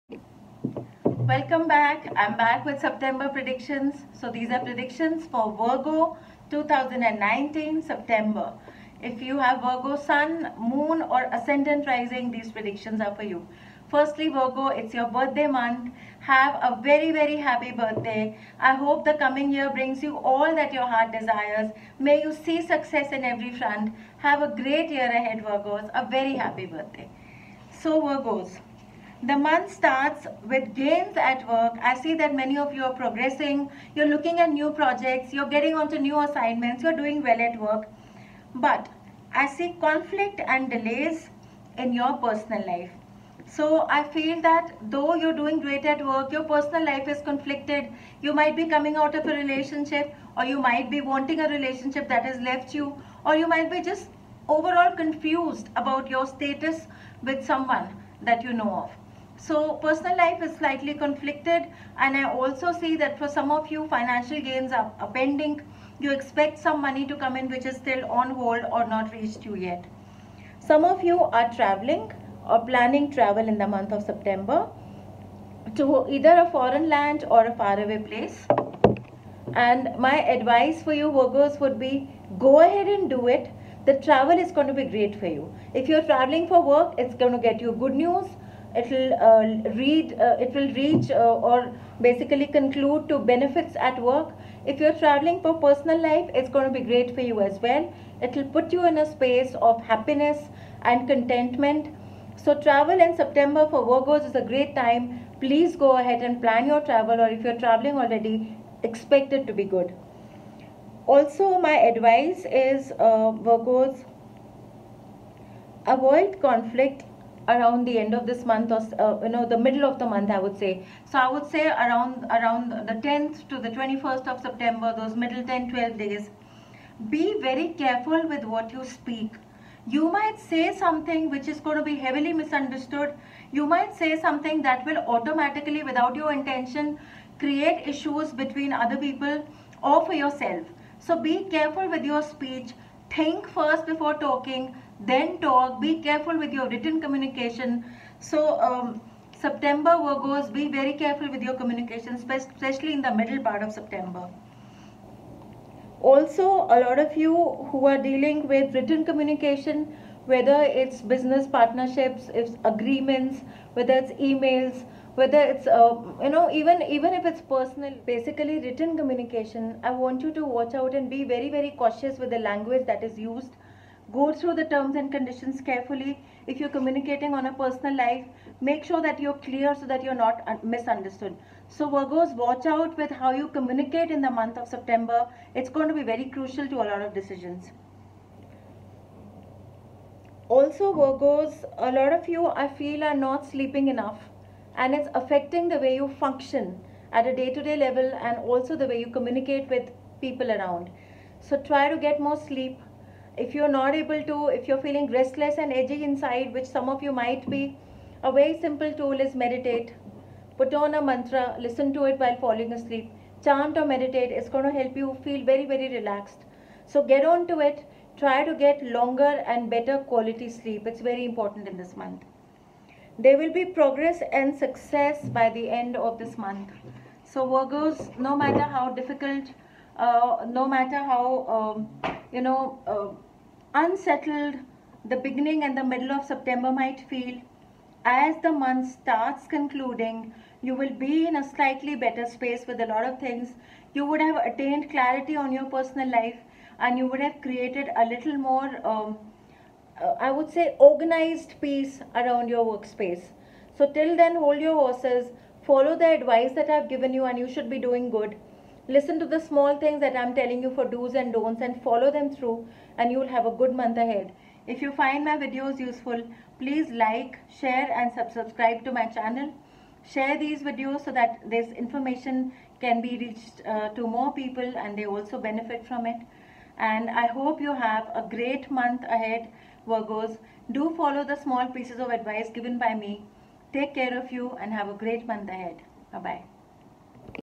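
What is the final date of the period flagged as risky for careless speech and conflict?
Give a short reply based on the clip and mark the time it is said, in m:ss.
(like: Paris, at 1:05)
21st, at 2:03.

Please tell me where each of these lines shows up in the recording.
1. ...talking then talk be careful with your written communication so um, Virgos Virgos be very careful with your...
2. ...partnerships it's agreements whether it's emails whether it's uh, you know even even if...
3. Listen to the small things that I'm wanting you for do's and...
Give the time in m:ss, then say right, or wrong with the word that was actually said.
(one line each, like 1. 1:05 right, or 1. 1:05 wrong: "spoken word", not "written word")
1. 2:24 wrong: "September", not "Virgos"
2. 2:41 right
3. 4:18 wrong: "telling", not "wanting".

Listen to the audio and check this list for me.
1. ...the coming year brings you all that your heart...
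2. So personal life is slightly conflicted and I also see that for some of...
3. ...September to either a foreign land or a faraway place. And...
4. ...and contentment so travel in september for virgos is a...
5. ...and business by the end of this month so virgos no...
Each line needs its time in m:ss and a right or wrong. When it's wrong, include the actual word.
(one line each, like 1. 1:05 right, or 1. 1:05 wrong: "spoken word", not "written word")
1. 0:19 right
2. 0:59 right
3. 1:14 right
4. 1:40 right
5. 3:44 wrong: "success", not "business".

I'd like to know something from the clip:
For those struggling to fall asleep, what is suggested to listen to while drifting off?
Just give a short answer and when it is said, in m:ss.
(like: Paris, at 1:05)
a mantra, at 3:30.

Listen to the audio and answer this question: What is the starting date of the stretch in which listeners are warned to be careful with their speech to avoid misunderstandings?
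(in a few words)
10th.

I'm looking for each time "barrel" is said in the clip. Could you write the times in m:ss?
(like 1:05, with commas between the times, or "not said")
not said.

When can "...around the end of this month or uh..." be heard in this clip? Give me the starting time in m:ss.
1:57.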